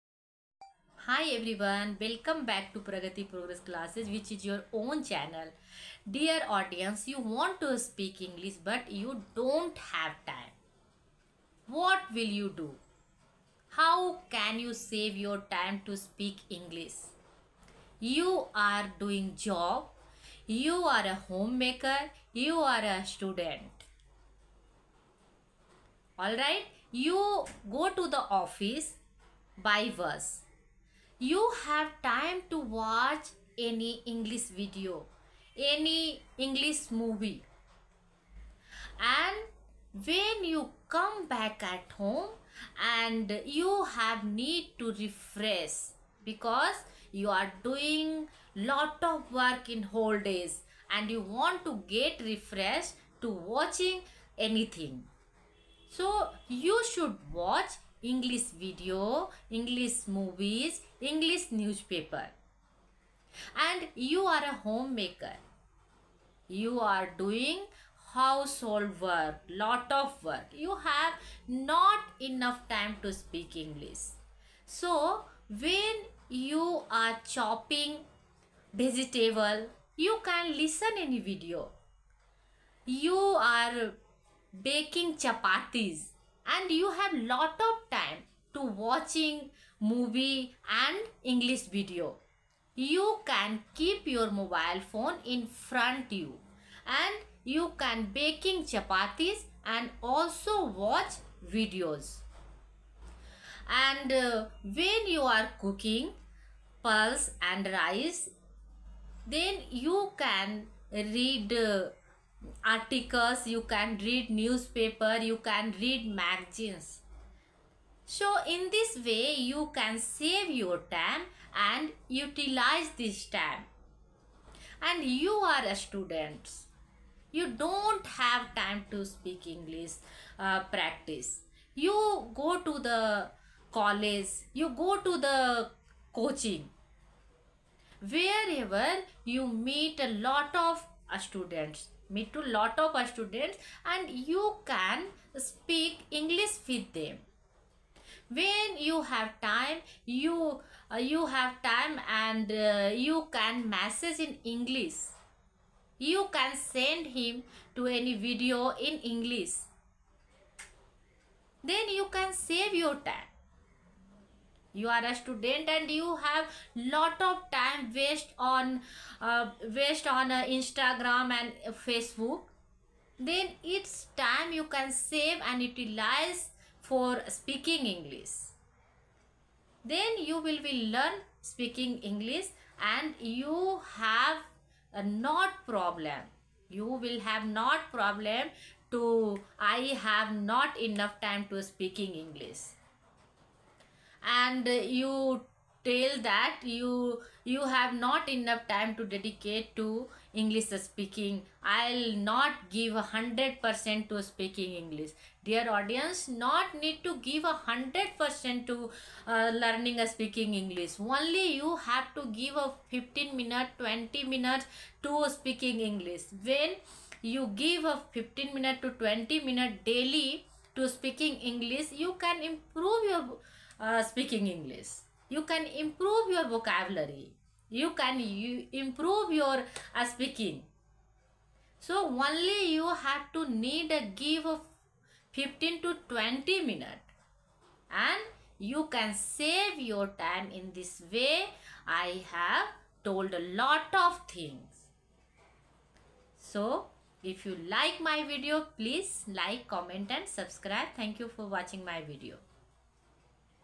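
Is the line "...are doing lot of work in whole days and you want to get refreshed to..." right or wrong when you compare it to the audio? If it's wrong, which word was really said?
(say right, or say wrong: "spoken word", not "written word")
right.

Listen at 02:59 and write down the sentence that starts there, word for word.
Then you will be learn speaking English and you have a not problem.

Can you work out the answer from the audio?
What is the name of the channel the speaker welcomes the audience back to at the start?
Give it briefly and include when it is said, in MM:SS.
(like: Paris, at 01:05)
Pragati Progress Classes, at 00:02.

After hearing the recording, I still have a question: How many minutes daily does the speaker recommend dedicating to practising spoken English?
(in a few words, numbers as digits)
15 to 20 minutes.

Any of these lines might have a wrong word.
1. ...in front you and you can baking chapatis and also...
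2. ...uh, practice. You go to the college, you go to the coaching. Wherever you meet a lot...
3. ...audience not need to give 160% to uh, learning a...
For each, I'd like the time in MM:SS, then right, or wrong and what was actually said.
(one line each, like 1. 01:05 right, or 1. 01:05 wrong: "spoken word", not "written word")
1. 01:35 right
2. 02:10 right
3. 03:25 wrong: "100", not "160".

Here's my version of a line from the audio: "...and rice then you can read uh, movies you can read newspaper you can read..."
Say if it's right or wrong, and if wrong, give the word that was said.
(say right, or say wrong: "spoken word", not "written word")
wrong: "articles", not "movies".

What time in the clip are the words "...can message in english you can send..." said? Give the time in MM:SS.
02:33.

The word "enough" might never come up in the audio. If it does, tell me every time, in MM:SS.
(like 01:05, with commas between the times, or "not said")
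01:12, 03:10, 03:18.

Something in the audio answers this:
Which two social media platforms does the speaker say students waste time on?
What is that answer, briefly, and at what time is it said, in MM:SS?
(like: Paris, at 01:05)
Instagram and Facebook, at 02:50.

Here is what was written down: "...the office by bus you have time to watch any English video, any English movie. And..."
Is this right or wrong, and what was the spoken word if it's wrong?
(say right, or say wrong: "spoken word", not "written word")
right.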